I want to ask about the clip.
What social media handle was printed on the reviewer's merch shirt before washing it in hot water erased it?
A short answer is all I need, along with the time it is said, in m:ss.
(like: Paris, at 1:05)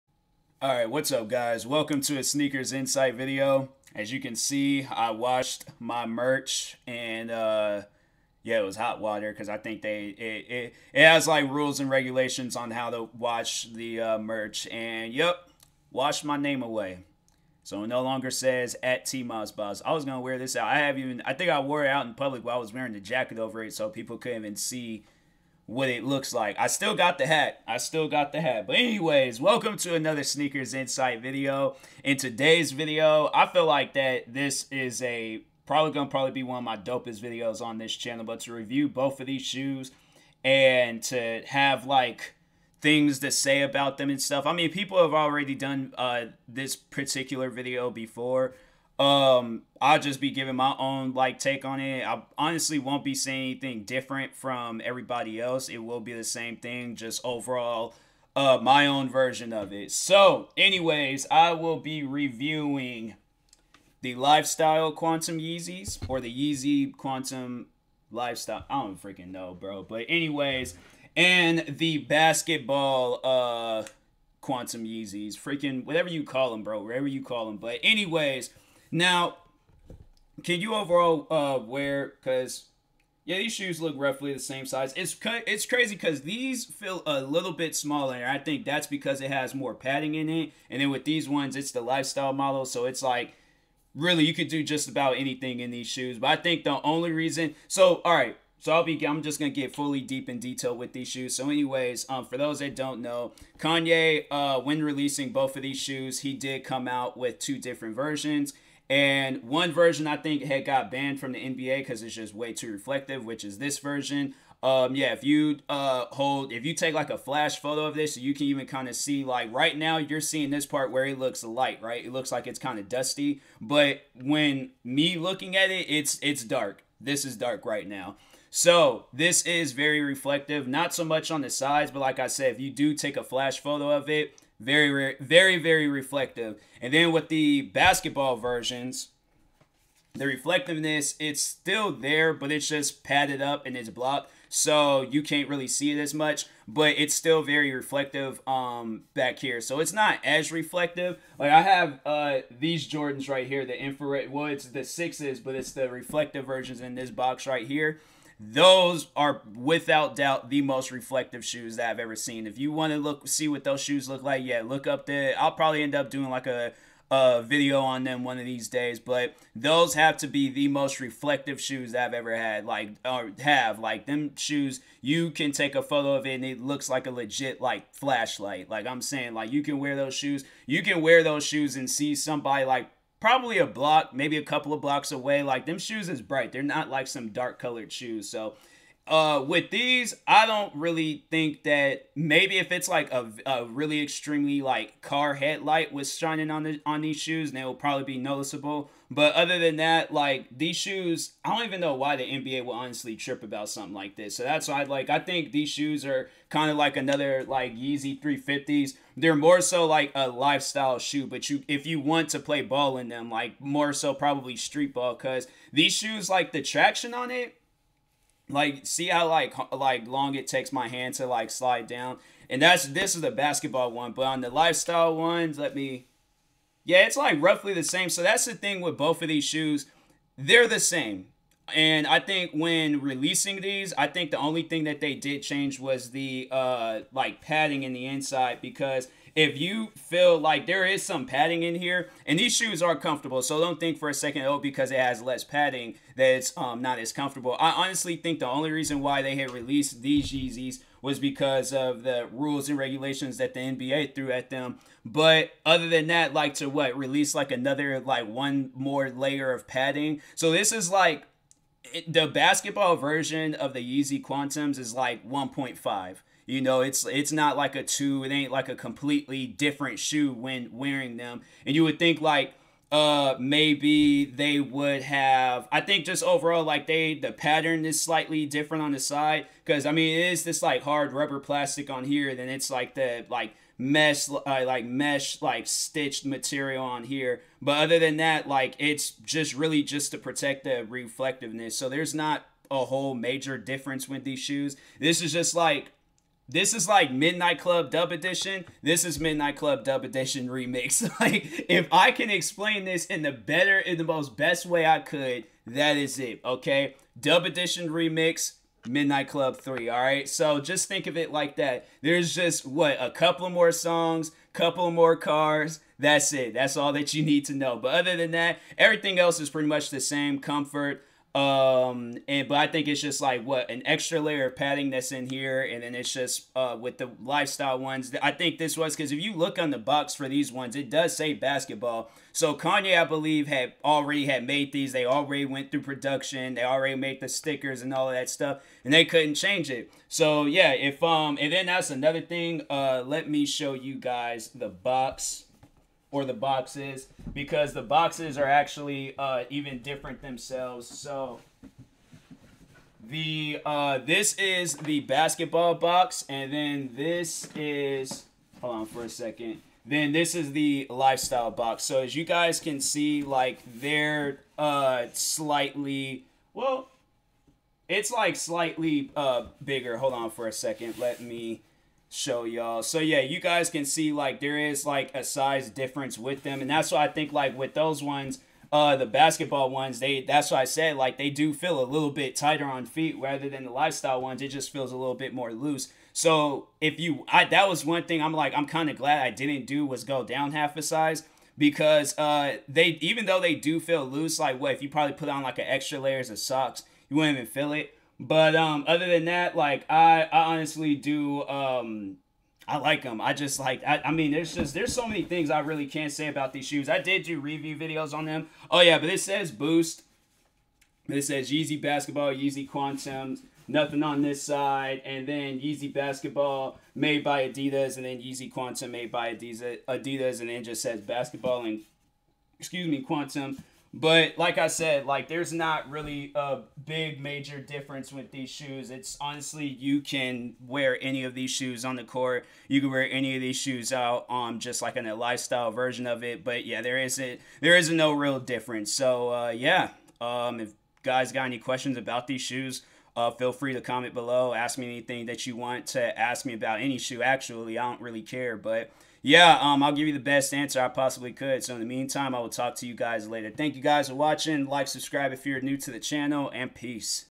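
TMossBoss, at 0:19.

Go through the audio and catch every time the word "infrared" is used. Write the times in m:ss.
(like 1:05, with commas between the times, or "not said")
2:33.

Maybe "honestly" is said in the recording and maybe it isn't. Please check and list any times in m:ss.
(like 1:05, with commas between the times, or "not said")
0:52, 3:22, 4:07, 6:40, 7:09.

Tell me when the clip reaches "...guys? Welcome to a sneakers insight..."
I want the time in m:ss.
0:01.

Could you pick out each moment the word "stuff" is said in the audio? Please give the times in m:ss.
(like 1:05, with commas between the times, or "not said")
0:44, 5:38.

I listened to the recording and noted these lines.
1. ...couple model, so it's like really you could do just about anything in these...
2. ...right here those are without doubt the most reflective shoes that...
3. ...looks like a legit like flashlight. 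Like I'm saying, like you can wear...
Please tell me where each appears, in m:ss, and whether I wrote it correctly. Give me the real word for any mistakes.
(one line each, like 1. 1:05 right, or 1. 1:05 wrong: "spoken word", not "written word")
1. 1:31 wrong: "lifestyle", not "couple"
2. 2:37 right
3. 2:56 right.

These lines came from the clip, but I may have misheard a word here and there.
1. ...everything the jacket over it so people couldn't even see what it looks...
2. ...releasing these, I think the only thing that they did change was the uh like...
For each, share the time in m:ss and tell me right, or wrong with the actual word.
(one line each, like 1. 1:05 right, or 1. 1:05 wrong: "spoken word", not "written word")
1. 0:22 wrong: "wearing", not "everything"
2. 3:53 right.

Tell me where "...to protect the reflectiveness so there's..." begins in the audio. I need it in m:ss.
4:50.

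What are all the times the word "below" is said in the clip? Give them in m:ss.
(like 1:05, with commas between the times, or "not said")
7:24.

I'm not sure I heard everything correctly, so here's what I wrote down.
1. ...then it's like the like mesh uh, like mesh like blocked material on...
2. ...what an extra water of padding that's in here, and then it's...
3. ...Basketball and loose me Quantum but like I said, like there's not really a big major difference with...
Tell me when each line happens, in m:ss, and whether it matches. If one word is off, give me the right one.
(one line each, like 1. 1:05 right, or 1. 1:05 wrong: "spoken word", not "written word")
1. 4:42 wrong: "stitched", not "blocked"
2. 5:23 wrong: "layer", not "water"
3. 7:01 wrong: "excuse", not "loose".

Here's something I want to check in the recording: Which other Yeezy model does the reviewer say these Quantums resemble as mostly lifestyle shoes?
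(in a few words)
Yeezy 350s.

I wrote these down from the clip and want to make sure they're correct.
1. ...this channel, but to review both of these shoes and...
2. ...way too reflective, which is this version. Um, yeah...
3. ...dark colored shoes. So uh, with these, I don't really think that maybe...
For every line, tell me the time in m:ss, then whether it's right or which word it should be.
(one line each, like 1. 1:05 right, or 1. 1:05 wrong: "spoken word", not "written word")
1. 0:37 right
2. 1:52 right
3. 3:07 right.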